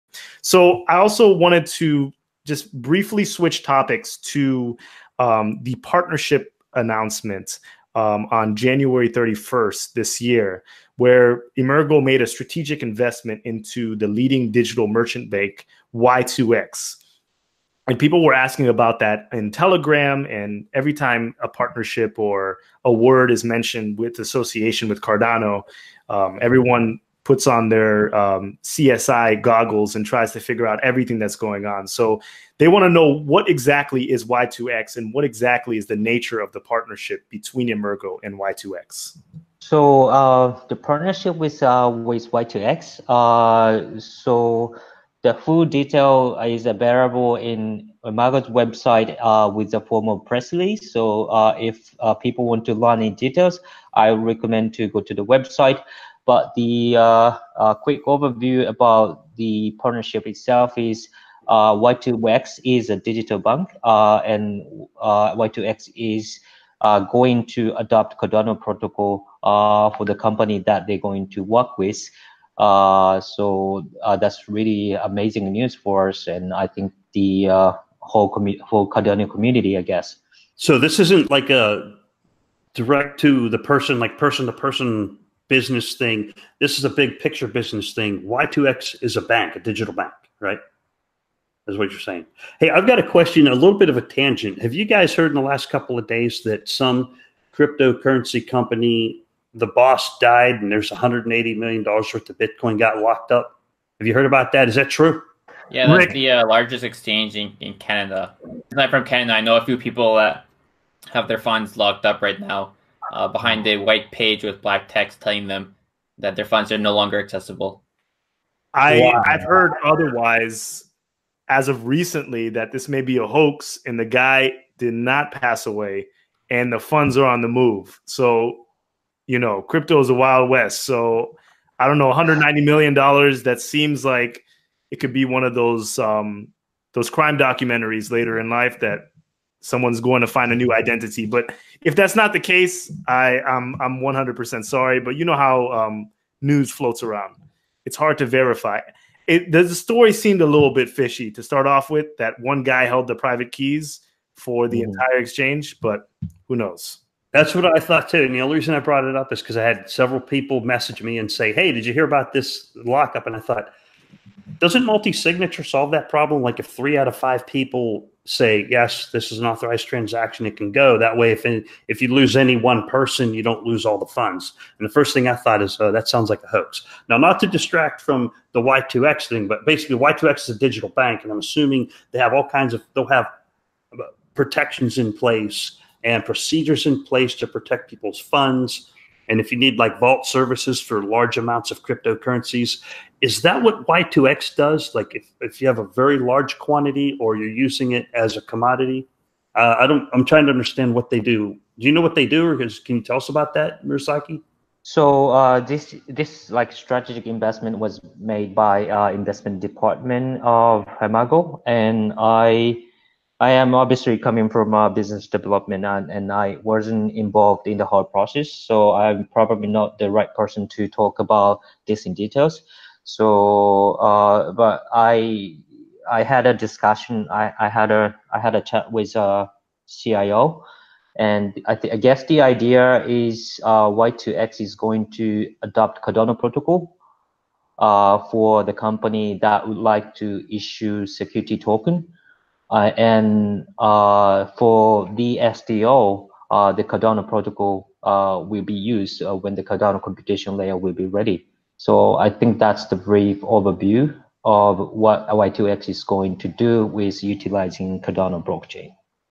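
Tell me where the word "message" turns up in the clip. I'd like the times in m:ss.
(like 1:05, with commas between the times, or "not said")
2:40.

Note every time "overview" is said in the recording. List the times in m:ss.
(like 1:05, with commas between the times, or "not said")
0:58, 4:13.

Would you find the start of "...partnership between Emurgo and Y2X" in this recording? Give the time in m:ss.
0:36.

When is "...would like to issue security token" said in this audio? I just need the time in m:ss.
3:59.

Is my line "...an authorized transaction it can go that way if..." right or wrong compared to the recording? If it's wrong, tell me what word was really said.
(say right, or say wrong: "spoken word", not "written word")
right.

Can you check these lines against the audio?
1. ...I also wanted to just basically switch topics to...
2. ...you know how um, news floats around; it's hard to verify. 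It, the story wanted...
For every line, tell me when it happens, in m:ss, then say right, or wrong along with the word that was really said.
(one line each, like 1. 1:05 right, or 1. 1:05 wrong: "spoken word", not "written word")
1. 0:00 wrong: "briefly", not "basically"
2. 2:25 wrong: "seemed", not "wanted".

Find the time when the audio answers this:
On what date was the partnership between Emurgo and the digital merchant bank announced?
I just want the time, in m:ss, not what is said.
0:08.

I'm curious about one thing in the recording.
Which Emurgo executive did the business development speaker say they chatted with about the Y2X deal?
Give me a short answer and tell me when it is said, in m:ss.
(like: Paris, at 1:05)
CIO, at 3:49.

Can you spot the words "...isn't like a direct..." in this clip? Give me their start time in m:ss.
1:20.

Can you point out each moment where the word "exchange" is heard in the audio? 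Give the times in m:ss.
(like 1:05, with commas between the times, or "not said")
1:46, 2:35.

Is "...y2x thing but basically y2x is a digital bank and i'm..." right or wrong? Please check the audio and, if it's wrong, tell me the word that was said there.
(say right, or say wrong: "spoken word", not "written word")
right.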